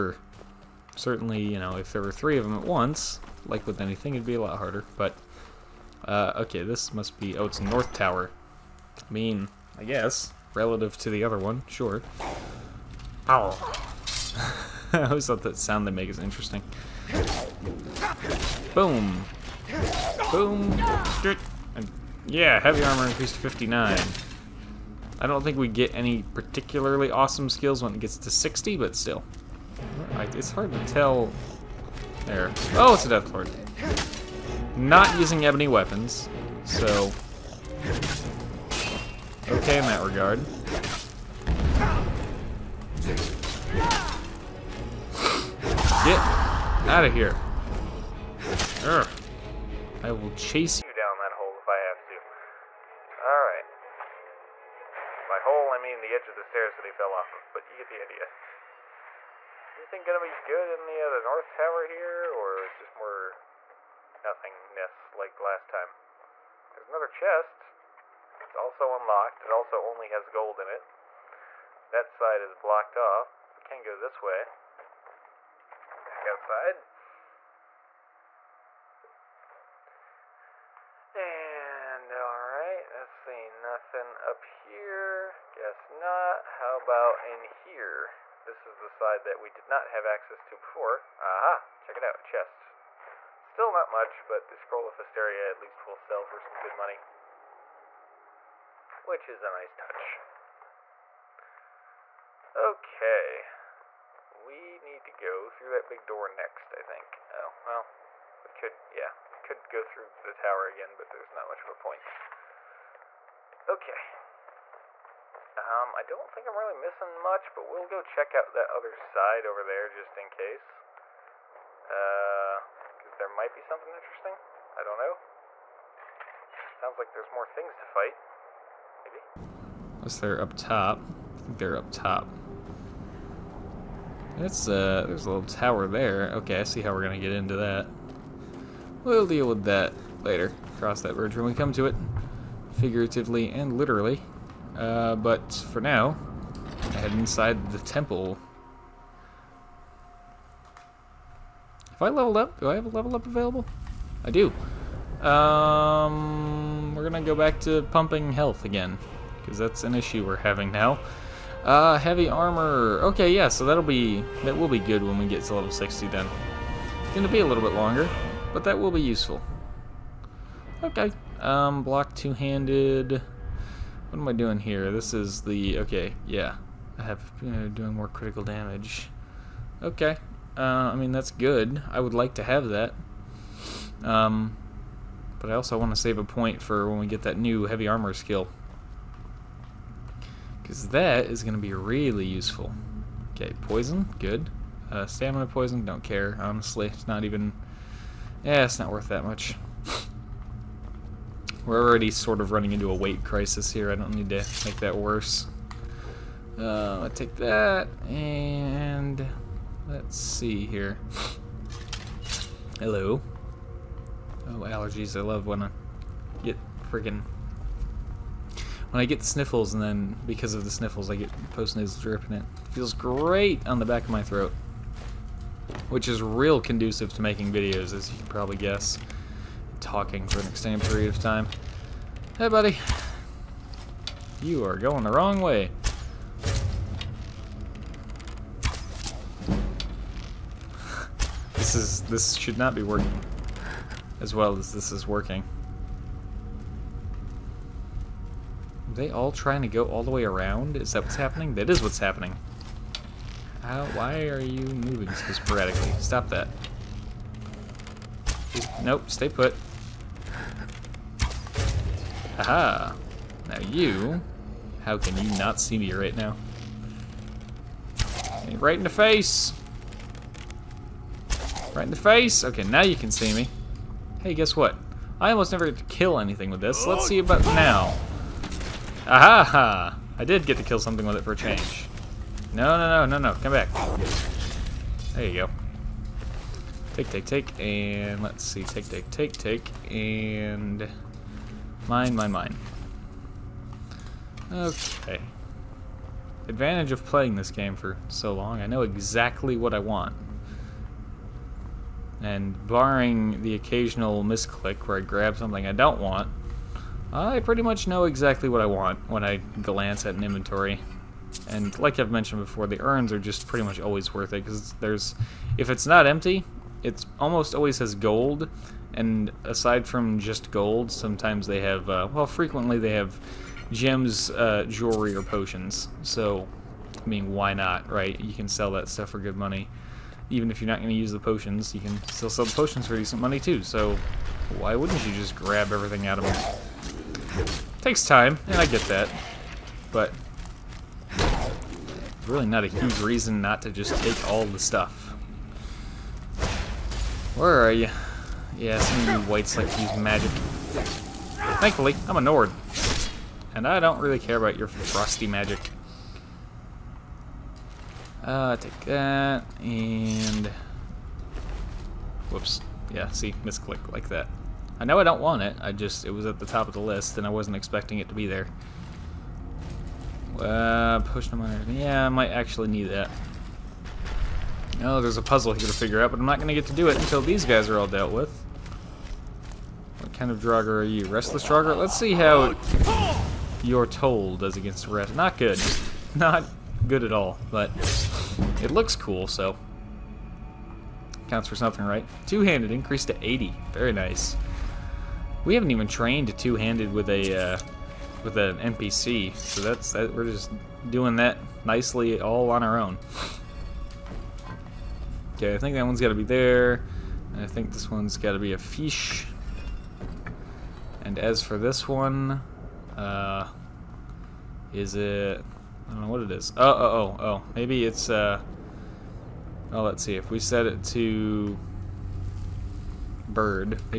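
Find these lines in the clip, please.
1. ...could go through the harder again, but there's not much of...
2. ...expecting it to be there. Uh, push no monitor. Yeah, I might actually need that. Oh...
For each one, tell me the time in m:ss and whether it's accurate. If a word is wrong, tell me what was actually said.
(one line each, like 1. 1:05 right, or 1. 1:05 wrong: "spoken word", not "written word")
1. 1:49 wrong: "tower", not "harder"
2. 6:07 right.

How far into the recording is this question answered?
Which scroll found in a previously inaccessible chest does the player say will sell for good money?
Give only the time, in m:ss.
1:34.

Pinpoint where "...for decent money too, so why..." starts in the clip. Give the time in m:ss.
5:32.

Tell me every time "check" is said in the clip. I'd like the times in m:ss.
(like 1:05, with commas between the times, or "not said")
1:31, 1:58.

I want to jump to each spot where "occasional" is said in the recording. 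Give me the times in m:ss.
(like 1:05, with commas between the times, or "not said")
5:03.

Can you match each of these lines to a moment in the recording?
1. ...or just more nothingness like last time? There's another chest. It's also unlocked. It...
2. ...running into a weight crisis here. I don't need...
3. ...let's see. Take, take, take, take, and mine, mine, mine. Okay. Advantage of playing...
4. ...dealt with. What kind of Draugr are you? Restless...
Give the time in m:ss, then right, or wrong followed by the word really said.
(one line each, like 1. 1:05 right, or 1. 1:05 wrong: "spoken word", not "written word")
1. 1:02 right
2. 3:22 right
3. 4:48 right
4. 6:17 right.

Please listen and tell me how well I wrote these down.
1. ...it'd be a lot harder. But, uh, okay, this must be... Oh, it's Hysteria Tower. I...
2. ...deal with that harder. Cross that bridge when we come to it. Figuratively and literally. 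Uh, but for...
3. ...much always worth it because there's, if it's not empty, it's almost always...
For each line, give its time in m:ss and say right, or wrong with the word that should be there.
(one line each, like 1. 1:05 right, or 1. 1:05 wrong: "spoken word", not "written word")
1. 0:04 wrong: "North", not "Hysteria"
2. 2:19 wrong: "later", not "harder"
3. 5:13 right.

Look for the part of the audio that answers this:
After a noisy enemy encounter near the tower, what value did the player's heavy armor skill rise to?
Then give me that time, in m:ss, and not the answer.
0:23.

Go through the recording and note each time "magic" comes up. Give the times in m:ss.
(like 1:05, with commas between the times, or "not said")
5:49, 5:55.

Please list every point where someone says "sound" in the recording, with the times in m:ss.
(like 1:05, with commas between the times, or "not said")
0:15, 2:06.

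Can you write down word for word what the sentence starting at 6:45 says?
Okay, I think that one's got to be there.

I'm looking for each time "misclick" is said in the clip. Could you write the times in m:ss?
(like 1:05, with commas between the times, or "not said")
5:04, 6:03.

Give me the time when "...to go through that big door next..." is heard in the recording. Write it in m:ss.
1:45.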